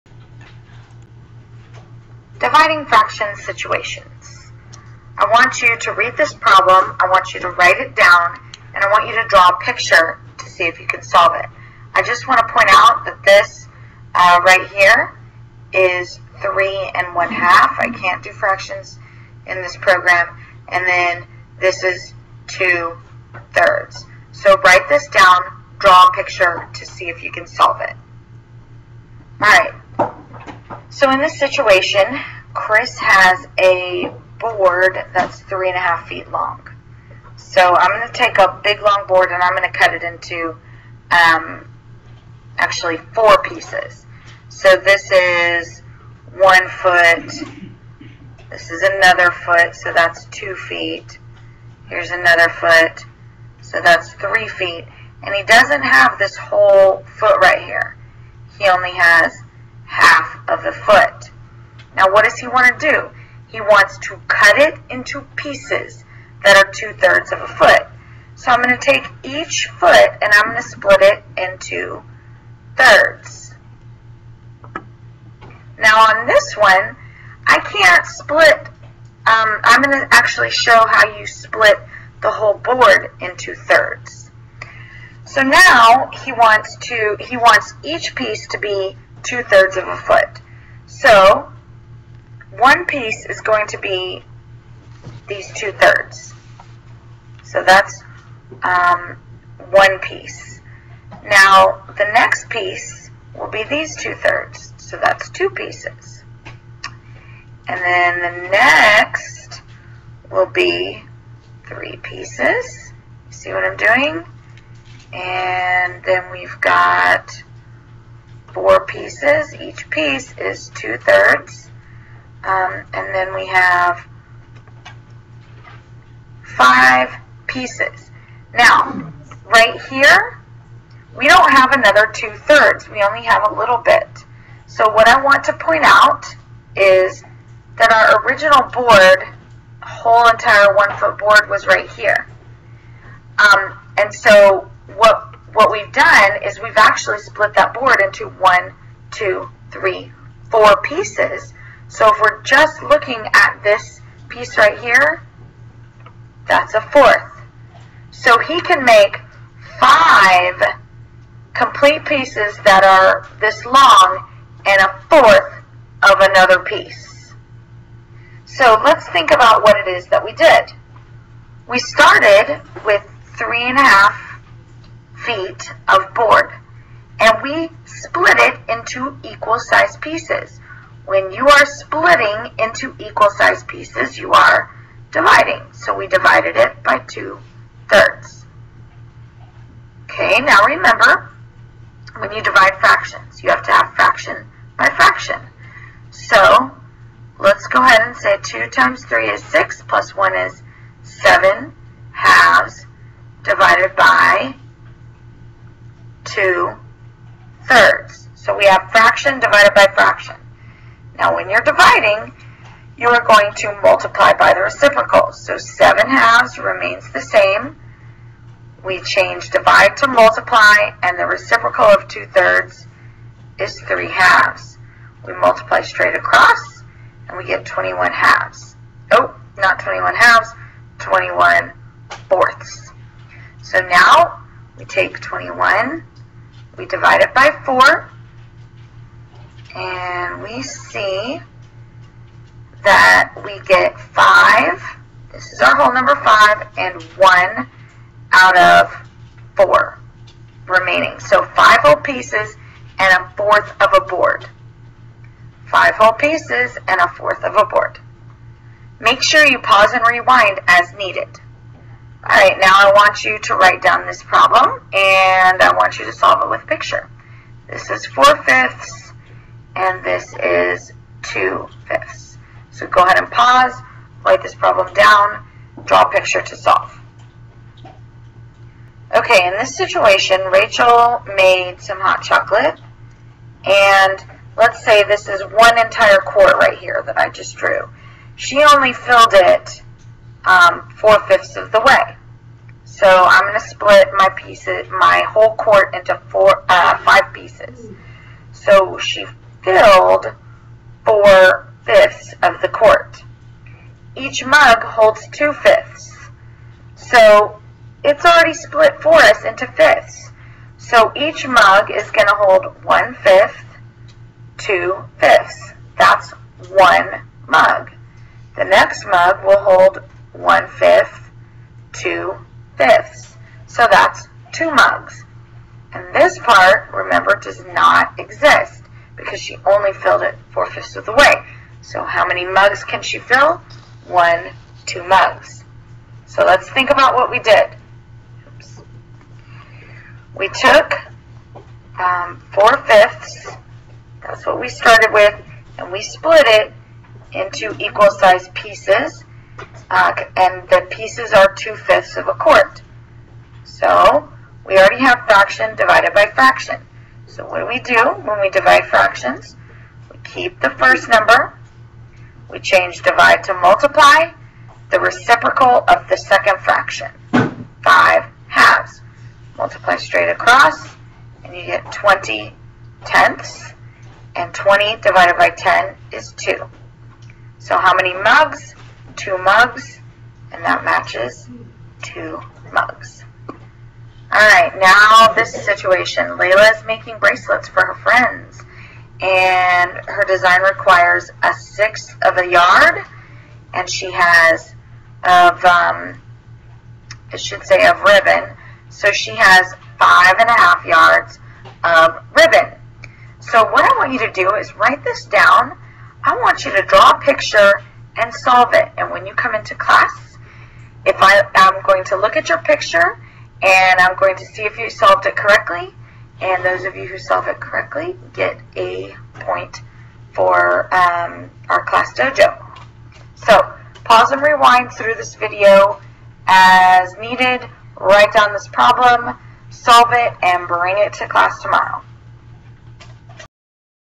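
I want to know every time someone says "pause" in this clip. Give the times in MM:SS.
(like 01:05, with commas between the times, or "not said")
04:19, 04:33, 07:04.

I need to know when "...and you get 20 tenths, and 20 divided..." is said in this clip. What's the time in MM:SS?
06:11.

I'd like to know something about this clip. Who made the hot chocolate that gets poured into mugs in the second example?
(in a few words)
Rachel.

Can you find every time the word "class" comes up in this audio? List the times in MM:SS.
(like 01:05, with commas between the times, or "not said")
06:49, 07:01, 07:11.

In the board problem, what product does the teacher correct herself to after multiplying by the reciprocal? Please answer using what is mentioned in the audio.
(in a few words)
21/4.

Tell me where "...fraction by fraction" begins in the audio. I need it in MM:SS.
03:13.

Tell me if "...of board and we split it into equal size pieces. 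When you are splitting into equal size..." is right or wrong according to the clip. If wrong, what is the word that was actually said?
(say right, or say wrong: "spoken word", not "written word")
right.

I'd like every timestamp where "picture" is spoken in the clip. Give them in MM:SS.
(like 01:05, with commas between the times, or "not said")
00:09, 00:26, 04:26, 04:36, 06:47, 06:52.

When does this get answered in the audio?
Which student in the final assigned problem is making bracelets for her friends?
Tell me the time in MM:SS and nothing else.
06:26.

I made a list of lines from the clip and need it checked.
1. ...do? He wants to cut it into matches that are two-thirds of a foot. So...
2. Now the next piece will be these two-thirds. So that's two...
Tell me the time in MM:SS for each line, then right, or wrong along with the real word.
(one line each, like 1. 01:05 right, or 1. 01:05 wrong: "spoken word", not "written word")
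1. 01:02 wrong: "pieces", not "matches"
2. 01:41 right.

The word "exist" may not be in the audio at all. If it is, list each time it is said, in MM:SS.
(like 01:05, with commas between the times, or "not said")
05:28.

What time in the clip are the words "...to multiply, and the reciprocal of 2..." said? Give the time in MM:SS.
03:39.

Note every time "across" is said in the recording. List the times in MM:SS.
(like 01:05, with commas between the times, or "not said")
03:46, 06:10.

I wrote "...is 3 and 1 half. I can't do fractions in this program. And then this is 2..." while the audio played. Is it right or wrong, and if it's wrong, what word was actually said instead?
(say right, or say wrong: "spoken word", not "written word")
right.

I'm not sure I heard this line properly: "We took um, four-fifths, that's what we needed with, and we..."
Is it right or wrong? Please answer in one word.
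wrong.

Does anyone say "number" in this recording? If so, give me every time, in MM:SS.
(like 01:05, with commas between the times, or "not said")
04:05, 06:01.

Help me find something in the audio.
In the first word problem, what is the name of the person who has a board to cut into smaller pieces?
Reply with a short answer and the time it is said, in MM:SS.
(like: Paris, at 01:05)
Chris, at 00:32.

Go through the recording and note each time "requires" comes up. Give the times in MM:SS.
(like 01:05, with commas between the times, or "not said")
06:30.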